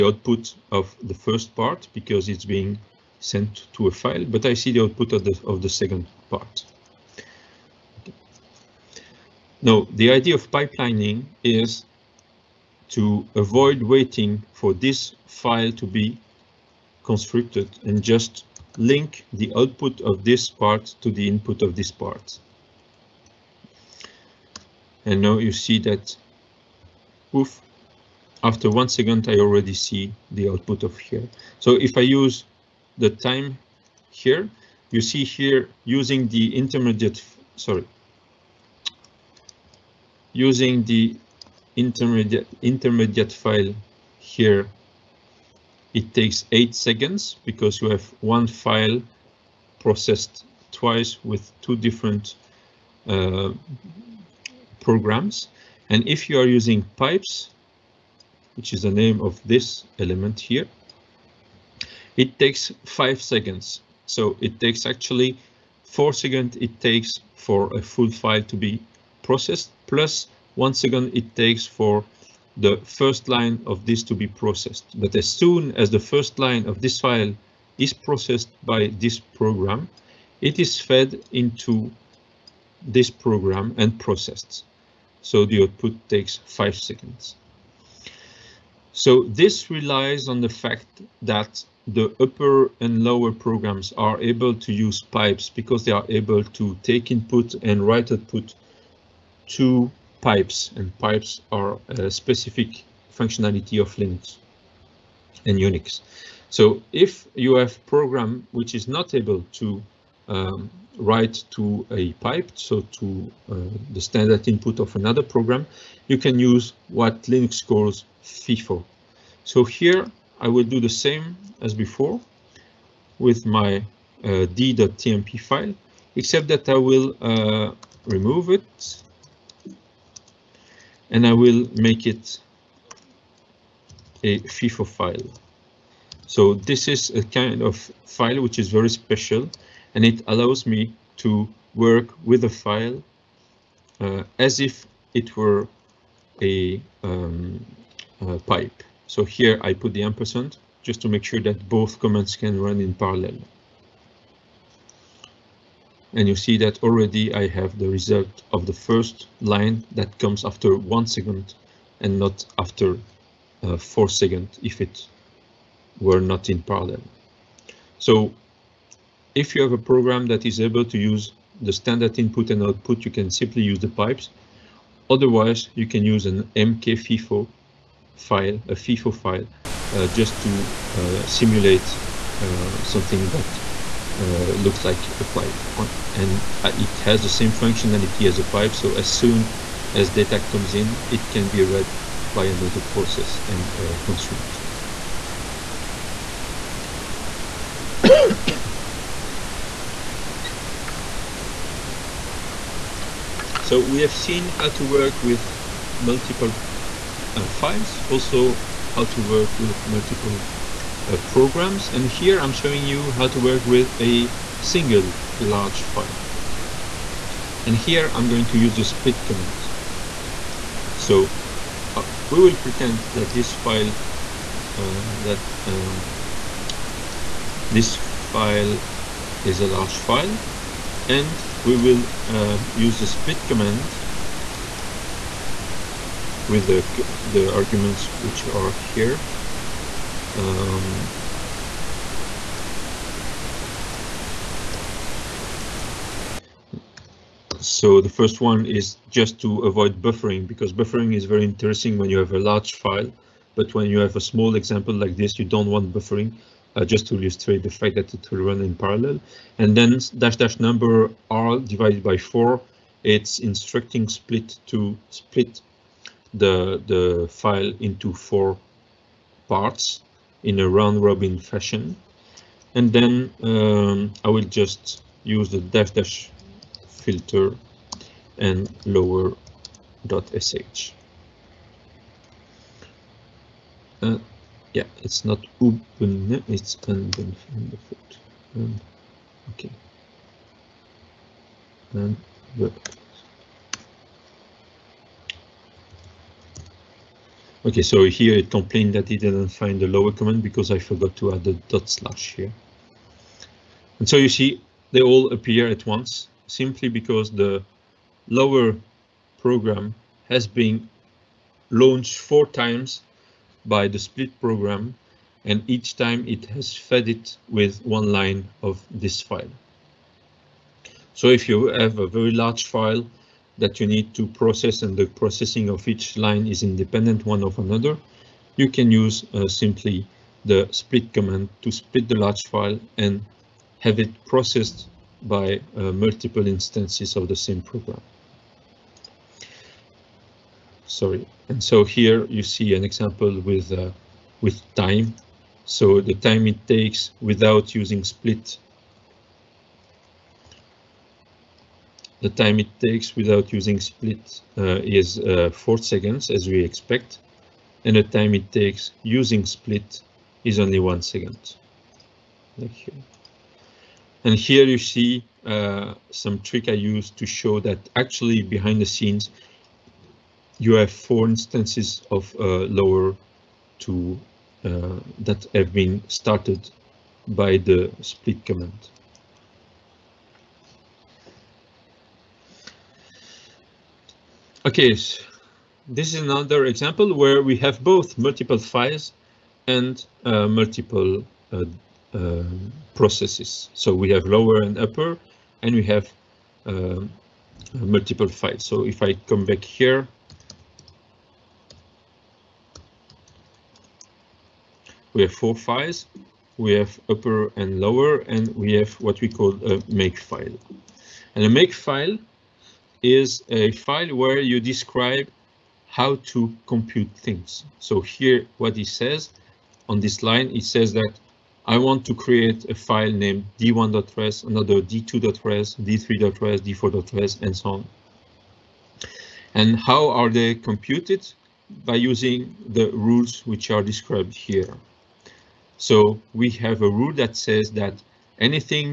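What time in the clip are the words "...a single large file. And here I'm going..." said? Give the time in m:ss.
3:33.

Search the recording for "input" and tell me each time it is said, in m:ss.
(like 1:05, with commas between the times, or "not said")
0:21, 1:37, 1:54, 2:52.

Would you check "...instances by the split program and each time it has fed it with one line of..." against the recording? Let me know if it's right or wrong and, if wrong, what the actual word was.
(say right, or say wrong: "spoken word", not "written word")
wrong: "times", not "instances".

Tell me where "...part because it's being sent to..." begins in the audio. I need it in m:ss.
0:01.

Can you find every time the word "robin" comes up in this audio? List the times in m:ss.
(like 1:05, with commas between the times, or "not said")
4:31.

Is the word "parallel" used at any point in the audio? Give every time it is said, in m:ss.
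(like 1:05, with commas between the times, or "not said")
2:32, 2:46, 4:18.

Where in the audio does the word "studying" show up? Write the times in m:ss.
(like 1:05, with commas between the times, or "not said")
not said.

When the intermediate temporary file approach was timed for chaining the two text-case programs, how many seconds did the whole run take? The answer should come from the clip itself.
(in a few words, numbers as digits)
8.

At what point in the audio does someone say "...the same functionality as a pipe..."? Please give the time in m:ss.
3:07.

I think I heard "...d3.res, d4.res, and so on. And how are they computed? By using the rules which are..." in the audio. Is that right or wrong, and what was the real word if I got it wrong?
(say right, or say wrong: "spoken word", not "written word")
right.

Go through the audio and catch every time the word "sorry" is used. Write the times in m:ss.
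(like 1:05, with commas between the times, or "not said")
0:37, 5:40.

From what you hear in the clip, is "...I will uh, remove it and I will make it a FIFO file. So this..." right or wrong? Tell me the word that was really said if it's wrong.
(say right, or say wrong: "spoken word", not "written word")
right.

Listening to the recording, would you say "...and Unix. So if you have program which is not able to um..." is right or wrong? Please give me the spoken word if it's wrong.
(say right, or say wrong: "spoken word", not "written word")
right.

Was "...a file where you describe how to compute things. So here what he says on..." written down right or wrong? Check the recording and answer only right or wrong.
right.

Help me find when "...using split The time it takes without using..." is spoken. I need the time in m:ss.
5:47.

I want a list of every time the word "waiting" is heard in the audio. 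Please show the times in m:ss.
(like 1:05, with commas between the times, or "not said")
0:13.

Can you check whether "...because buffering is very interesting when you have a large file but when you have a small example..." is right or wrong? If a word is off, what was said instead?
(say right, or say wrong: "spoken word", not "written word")
right.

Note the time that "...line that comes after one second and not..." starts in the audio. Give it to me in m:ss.
2:39.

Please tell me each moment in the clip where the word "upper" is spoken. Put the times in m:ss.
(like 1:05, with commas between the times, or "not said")
1:32, 6:34, 6:47.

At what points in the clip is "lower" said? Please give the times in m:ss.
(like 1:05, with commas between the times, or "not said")
1:33, 4:38, 4:59, 5:08, 6:12, 6:34, 6:47.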